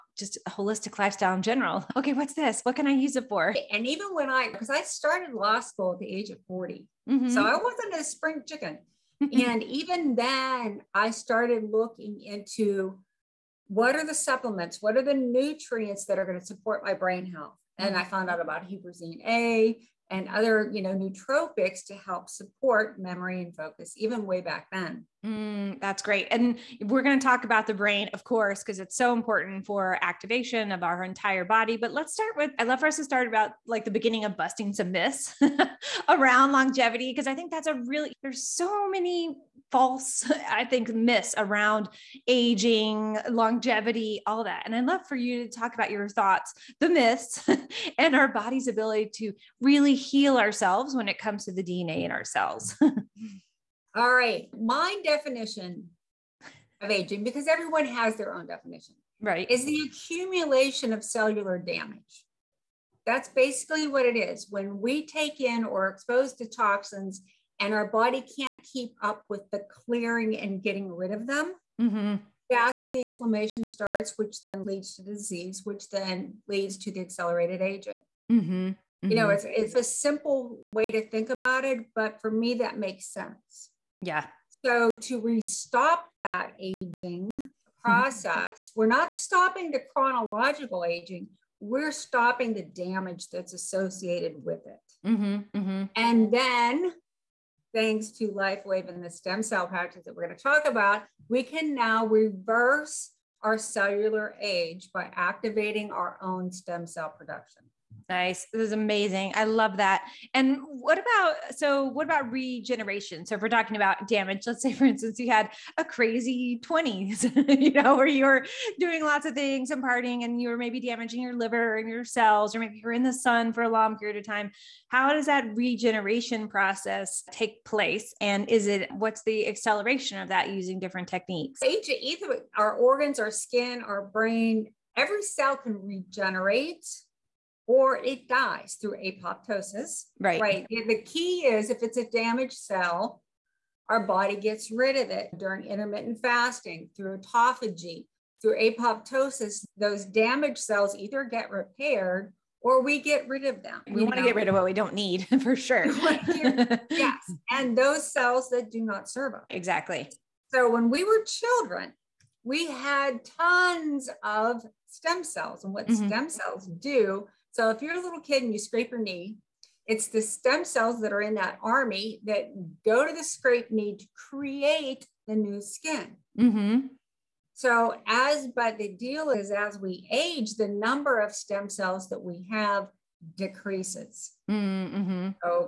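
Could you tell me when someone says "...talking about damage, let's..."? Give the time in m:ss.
1:53.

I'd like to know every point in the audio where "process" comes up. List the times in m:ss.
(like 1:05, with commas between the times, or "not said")
1:27, 2:06.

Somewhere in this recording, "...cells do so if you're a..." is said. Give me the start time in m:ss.
2:46.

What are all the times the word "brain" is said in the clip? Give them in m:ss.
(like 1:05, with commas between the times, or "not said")
0:16, 0:27, 2:14.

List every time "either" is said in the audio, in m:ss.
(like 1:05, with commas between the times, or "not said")
2:11, 2:30.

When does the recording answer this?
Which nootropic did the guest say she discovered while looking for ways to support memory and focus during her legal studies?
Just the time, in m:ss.
0:18.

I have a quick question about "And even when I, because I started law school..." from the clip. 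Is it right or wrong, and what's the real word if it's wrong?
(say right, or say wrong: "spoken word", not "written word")
right.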